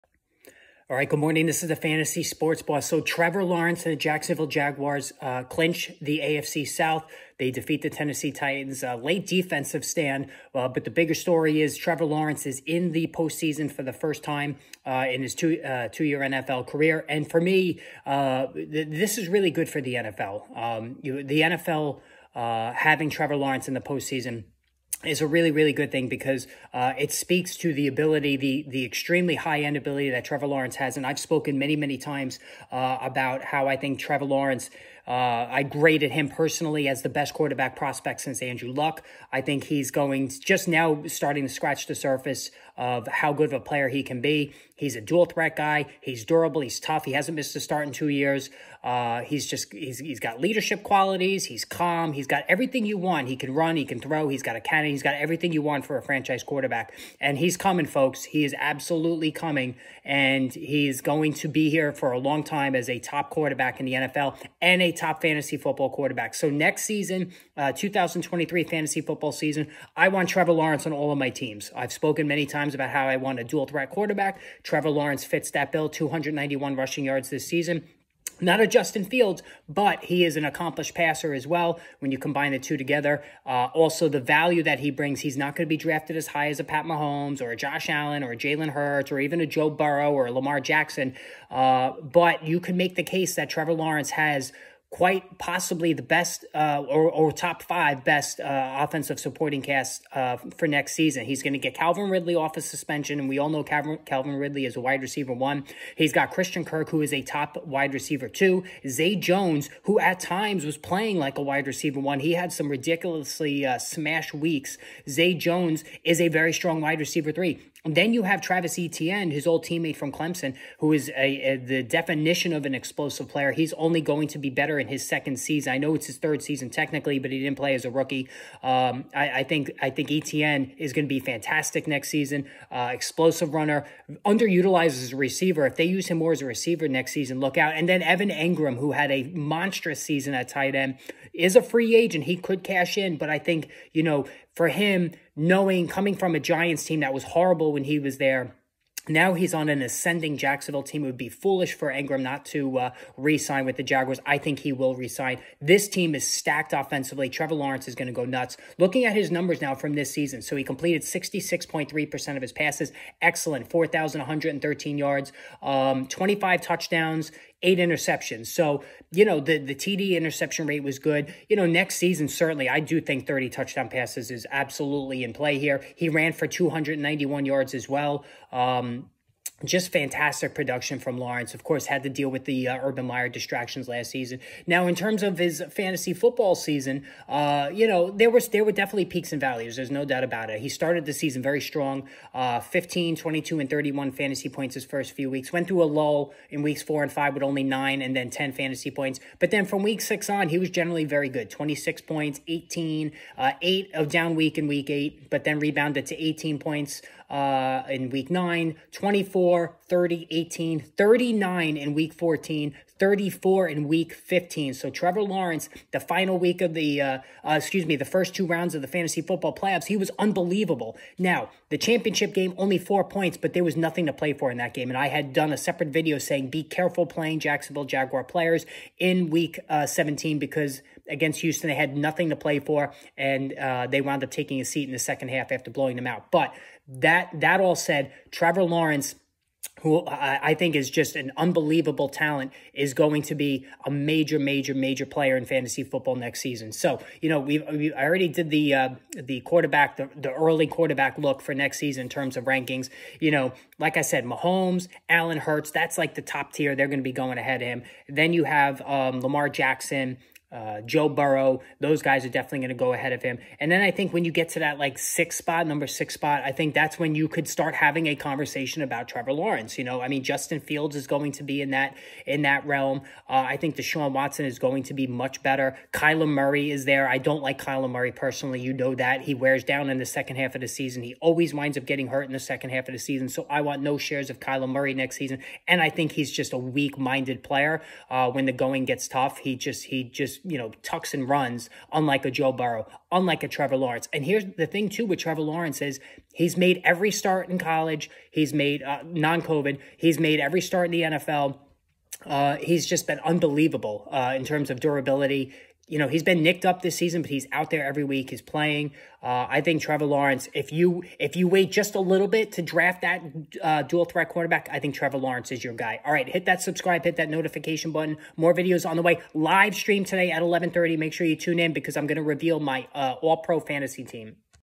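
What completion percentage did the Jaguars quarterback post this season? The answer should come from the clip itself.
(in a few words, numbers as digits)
66.3%.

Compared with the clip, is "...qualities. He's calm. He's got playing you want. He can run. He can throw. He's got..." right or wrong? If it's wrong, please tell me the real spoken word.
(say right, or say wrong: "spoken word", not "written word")
wrong: "everything", not "playing".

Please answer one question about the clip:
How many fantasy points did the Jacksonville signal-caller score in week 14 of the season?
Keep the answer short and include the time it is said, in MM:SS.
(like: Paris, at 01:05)
39, at 03:30.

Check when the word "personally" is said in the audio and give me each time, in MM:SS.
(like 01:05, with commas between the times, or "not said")
00:36, 04:38.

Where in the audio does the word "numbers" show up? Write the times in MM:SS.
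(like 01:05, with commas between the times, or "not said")
02:39, 04:25.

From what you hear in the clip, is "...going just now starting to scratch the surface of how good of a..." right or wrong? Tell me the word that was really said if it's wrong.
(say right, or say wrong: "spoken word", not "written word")
right.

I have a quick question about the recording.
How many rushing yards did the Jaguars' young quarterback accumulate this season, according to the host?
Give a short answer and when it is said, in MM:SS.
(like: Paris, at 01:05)
291, at 01:15.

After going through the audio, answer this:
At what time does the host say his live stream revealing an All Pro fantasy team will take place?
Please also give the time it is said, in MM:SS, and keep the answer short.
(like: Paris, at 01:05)
11:30, at 05:20.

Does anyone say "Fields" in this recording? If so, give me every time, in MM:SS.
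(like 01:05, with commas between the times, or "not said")
01:19, 04:30.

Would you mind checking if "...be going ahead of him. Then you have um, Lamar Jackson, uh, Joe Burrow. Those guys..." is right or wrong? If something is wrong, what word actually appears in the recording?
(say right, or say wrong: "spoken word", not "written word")
right.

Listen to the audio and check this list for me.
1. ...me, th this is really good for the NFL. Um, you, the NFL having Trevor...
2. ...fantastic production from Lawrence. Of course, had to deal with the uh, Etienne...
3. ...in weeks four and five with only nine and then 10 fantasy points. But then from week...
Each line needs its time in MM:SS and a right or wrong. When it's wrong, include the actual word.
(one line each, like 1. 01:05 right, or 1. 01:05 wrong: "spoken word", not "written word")
1. 00:17 right
2. 02:59 wrong: "Urban", not "Etienne"
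3. 03:16 right.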